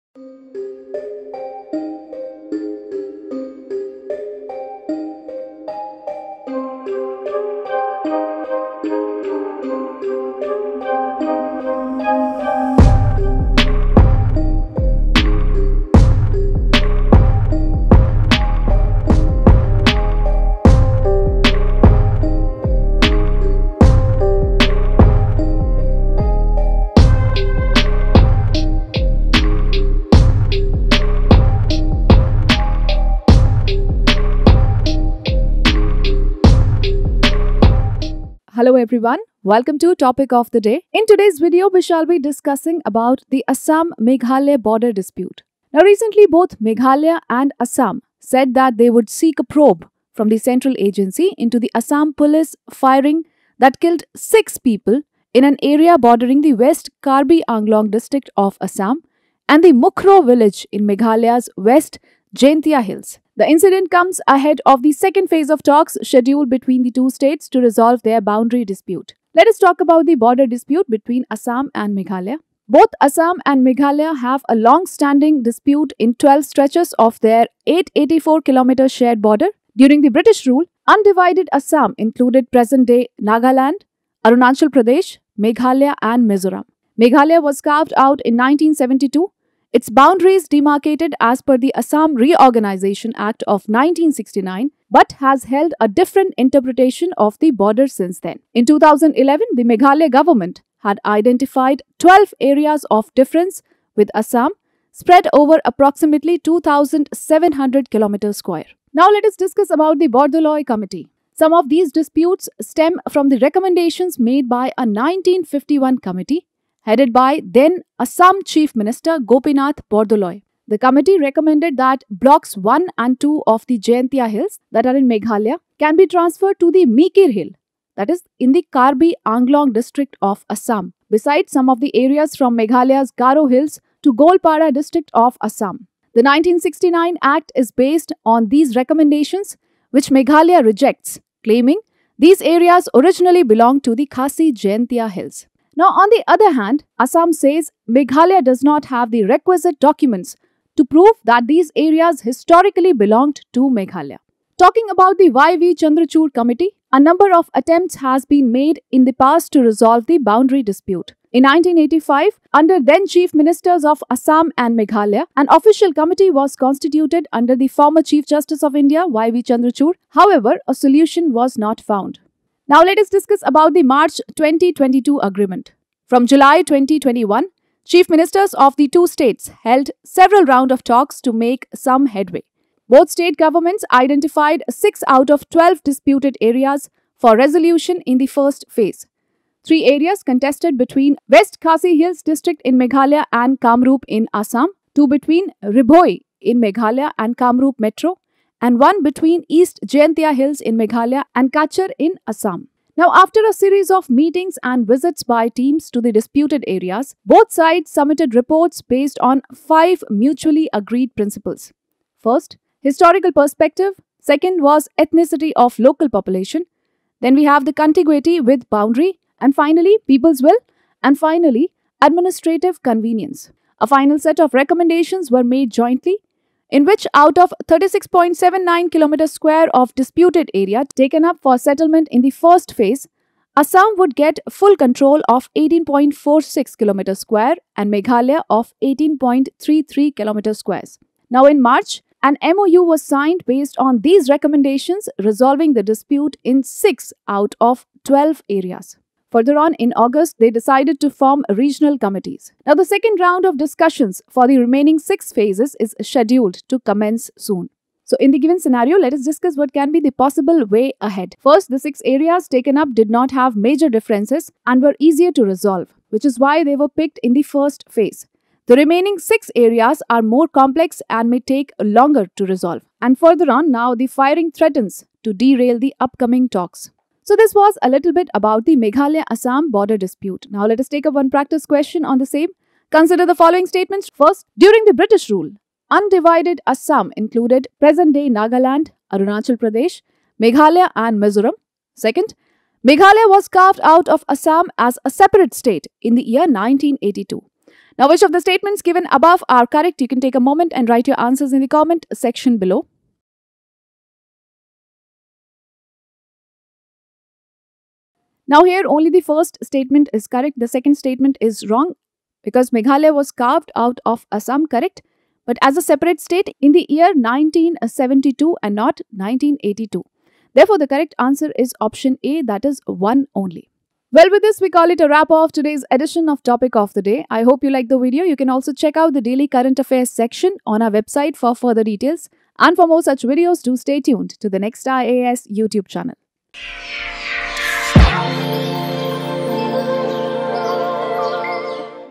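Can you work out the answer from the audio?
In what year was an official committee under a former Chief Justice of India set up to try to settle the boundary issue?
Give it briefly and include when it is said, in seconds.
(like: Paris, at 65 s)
1985, at 161 s.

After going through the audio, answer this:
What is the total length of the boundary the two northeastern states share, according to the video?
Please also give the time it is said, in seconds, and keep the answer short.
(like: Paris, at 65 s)
884 km, at 77 s.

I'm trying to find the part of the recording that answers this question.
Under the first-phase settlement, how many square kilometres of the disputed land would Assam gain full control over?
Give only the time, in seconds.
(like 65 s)
235 s.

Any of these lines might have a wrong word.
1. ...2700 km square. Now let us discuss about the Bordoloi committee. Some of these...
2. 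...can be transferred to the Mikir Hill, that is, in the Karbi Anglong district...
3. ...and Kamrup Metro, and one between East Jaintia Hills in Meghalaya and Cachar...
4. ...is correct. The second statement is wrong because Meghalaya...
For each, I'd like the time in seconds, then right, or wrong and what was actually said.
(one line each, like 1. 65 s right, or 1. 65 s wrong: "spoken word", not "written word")
1. 106 s right
2. 125 s right
3. 197 s right
4. 310 s right.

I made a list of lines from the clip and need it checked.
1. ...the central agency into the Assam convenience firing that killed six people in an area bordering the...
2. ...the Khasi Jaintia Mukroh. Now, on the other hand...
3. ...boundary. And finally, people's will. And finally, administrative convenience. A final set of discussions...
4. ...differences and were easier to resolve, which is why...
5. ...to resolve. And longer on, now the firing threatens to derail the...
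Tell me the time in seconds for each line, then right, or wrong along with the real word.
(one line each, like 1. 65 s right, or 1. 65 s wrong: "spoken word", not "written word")
1. 50 s wrong: "police", not "convenience"
2. 143 s wrong: "Hills", not "Mukroh"
3. 218 s wrong: "recommendations", not "discussions"
4. 263 s right
5. 272 s wrong: "further", not "longer".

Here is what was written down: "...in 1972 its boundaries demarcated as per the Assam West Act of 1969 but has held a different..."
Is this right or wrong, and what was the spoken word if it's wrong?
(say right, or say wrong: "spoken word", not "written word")
wrong: "Reorganization", not "West".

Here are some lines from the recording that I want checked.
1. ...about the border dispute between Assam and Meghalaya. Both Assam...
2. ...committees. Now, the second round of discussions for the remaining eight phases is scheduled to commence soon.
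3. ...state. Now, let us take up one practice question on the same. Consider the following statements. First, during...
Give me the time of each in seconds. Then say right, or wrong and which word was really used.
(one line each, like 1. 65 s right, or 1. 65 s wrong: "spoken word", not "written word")
1. 69 s right
2. 251 s wrong: "six", not "eight"
3. 279 s wrong: "dispute", not "state".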